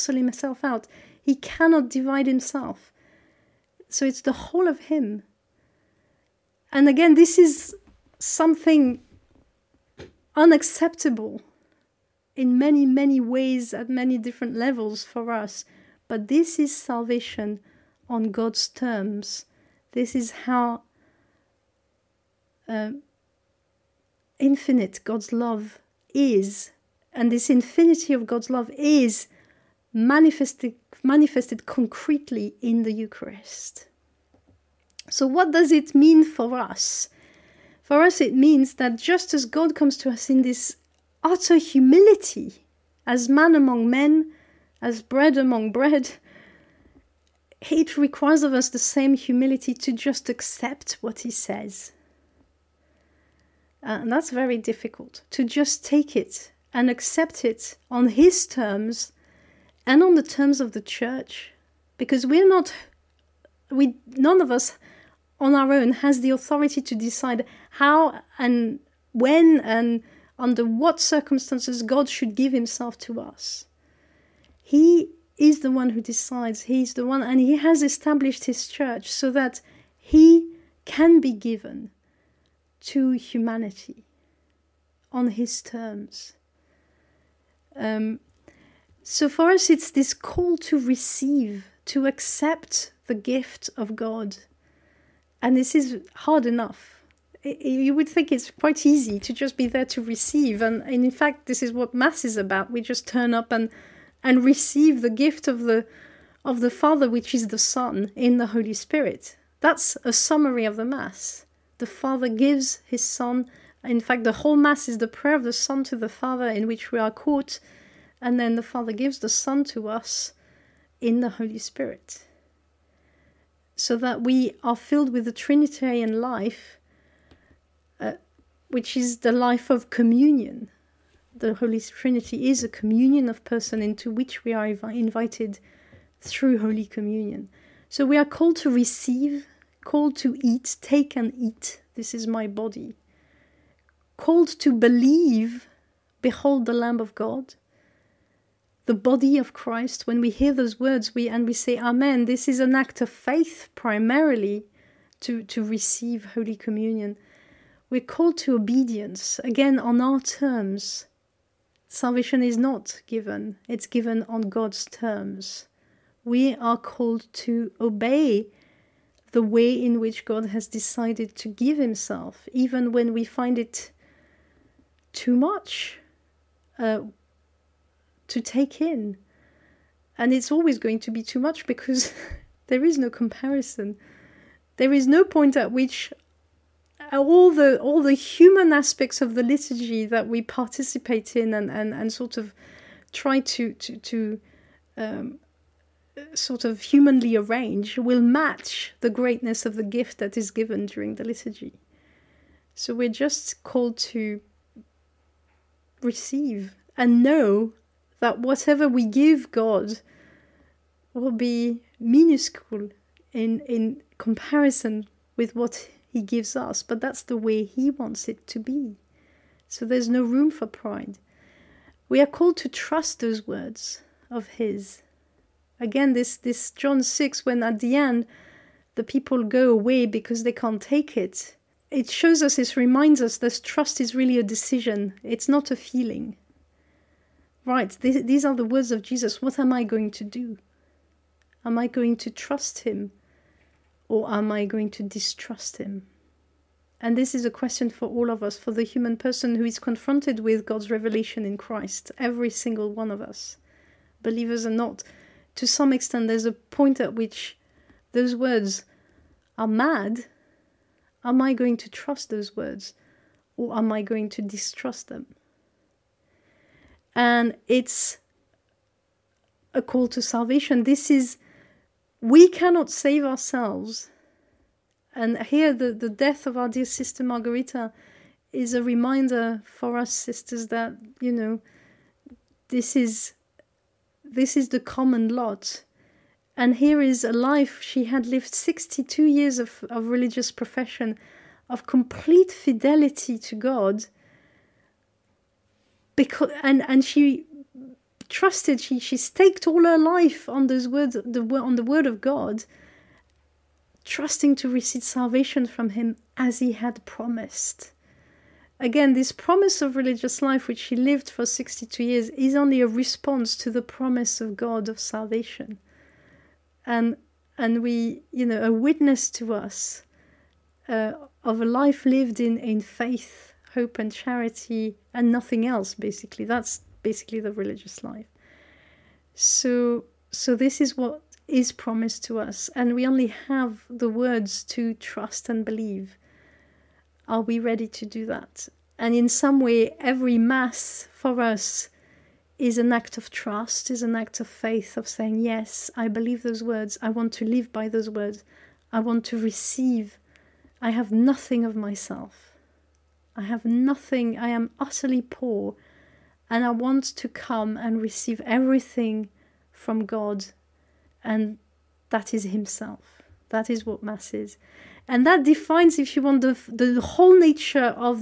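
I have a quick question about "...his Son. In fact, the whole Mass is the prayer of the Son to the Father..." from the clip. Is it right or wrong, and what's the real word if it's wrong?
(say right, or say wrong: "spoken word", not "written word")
right.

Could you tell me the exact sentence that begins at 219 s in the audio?
So there's no room for pride.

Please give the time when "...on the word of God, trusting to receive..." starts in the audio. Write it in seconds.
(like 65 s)
301 s.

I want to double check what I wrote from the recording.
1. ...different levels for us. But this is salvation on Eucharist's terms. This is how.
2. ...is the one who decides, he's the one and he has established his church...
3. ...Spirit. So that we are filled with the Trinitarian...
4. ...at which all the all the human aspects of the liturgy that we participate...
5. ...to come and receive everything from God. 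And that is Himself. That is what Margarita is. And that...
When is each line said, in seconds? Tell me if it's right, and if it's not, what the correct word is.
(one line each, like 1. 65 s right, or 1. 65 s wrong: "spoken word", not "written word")
1. 14 s wrong: "God", not "Eucharist"
2. 75 s right
3. 121 s right
4. 185 s right
5. 357 s wrong: "Mass", not "Margarita".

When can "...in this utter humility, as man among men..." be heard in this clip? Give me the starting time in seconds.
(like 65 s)
40 s.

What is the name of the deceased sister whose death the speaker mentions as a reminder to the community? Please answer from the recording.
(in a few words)
Margarita.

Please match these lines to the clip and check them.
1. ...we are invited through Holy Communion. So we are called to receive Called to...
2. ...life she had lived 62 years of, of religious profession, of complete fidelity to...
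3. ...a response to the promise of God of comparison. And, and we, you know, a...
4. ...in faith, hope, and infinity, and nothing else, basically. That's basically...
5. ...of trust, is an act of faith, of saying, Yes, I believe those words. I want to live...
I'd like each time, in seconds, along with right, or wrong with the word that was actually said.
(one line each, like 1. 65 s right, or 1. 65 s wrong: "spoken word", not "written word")
1. 134 s right
2. 287 s right
3. 312 s wrong: "salvation", not "comparison"
4. 322 s wrong: "charity", not "infinity"
5. 343 s right.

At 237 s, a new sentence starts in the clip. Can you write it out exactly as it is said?
Right, th- these are the words of Jesus.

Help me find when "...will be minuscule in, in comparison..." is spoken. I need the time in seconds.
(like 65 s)
211 s.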